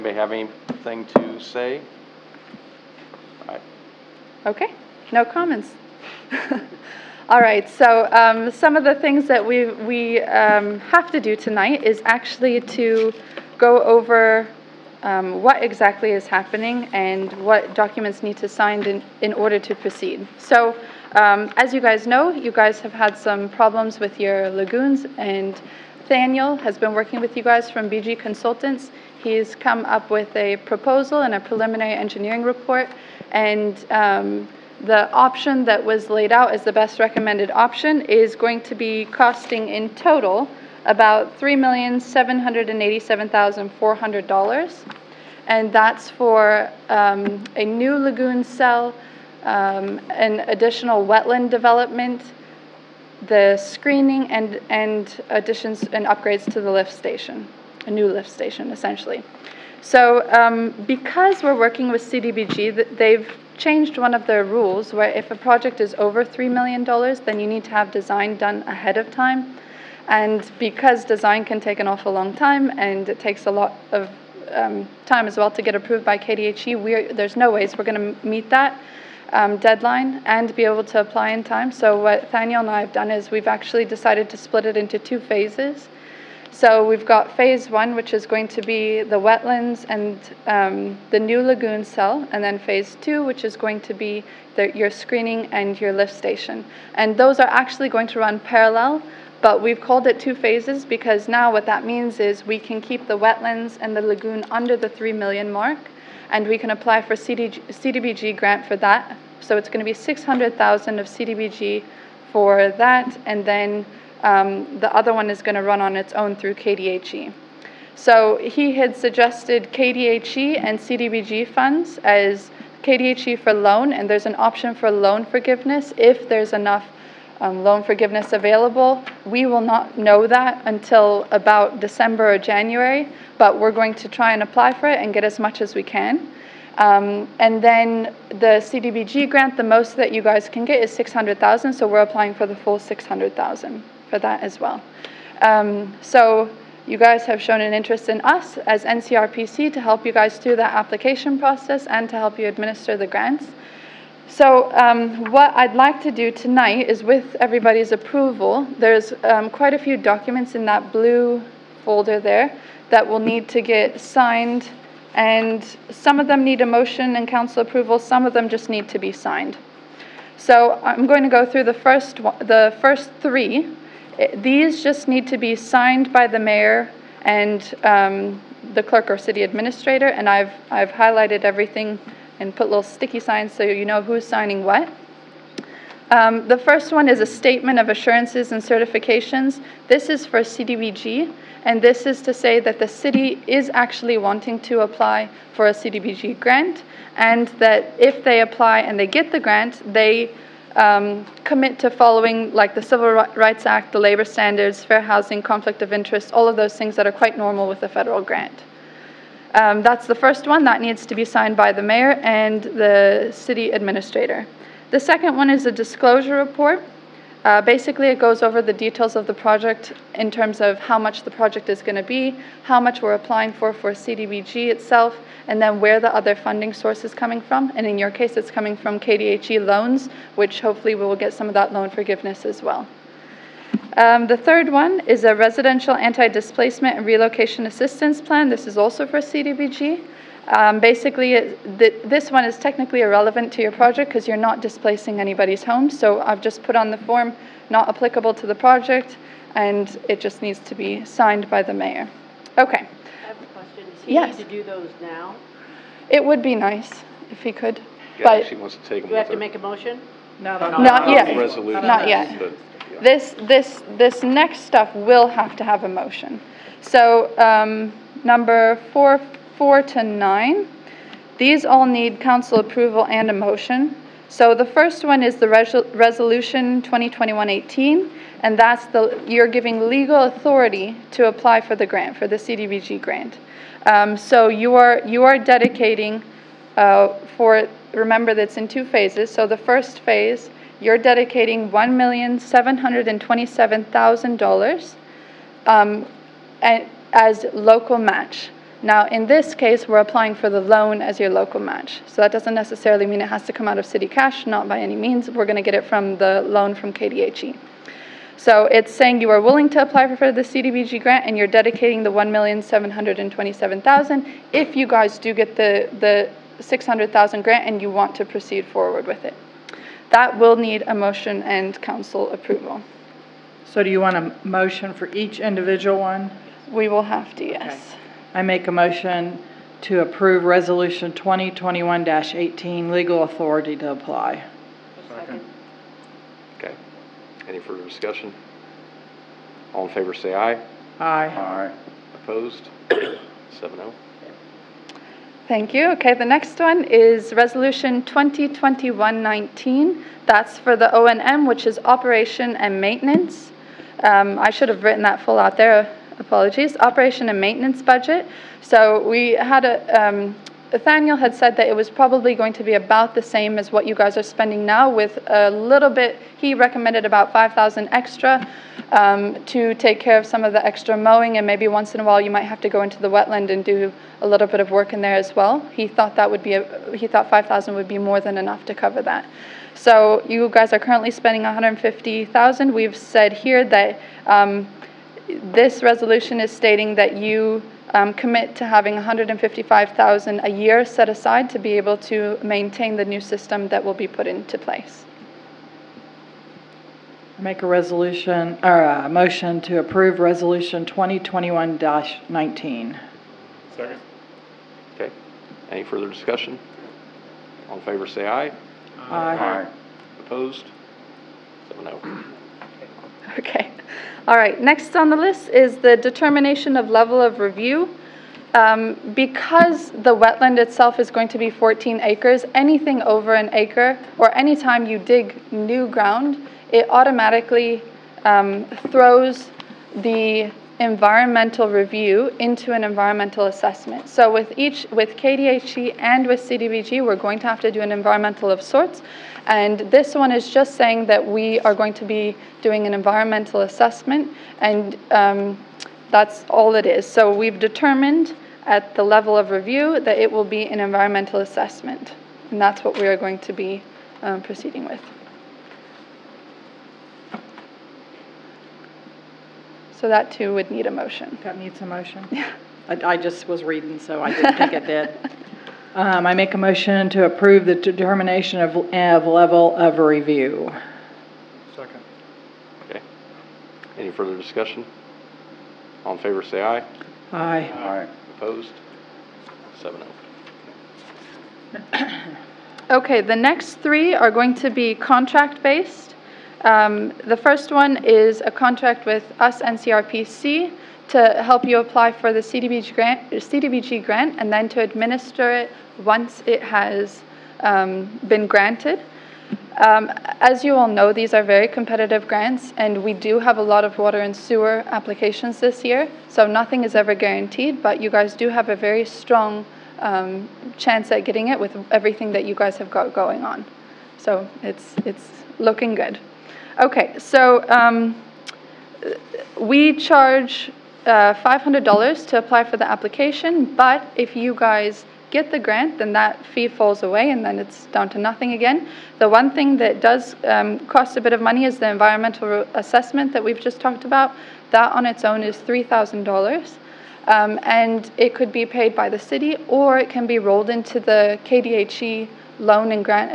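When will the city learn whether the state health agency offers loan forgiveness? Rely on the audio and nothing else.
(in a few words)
December or January.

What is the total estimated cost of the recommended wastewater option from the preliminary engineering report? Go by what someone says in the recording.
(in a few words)
$3,787,400.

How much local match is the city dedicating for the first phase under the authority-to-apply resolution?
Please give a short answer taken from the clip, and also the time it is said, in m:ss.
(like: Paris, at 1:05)
$1,727,000, at 4:51.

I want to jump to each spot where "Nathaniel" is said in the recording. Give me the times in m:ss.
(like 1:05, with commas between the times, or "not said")
6:00.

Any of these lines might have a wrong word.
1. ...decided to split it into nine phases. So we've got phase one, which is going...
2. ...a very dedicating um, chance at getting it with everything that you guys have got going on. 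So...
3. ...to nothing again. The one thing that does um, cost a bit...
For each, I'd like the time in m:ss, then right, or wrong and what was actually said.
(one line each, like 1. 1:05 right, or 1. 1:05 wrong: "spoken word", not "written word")
1. 1:23 wrong: "two", not "nine"
2. 8:28 wrong: "strong", not "dedicating"
3. 8:48 right.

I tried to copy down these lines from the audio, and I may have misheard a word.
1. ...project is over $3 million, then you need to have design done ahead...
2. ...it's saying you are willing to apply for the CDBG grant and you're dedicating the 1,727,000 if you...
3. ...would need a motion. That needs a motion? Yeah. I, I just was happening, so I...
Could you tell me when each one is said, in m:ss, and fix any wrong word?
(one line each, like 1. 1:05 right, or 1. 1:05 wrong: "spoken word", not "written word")
1. 1:05 right
2. 5:08 right
3. 7:40 wrong: "reading", not "happening".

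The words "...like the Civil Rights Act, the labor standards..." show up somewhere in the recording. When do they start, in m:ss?
3:22.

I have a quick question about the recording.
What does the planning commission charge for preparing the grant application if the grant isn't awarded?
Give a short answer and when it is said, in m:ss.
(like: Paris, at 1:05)
$500, at 8:41.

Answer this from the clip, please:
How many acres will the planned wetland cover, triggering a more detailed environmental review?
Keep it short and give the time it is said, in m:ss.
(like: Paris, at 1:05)
14 acres, at 7:01.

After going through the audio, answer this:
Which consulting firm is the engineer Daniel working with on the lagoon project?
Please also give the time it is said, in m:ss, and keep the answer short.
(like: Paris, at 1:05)
BG Consultants, at 0:27.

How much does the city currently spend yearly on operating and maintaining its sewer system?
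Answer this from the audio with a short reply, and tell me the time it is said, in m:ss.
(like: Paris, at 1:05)
150,000, at 6:21.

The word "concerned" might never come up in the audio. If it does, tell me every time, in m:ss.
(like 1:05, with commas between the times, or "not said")
not said.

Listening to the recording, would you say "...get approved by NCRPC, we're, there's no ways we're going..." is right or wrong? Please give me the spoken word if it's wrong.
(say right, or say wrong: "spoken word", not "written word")
wrong: "KDHE", not "NCRPC".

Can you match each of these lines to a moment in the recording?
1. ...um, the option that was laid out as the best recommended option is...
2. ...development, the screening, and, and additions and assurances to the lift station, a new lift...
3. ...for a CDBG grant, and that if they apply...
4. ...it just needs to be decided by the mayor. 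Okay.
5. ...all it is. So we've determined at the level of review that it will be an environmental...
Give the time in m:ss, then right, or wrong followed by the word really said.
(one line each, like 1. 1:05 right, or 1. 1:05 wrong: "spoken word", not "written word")
1. 0:33 right
2. 0:51 wrong: "upgrades", not "assurances"
3. 3:15 right
4. 4:10 wrong: "signed", not "decided"
5. 7:26 right.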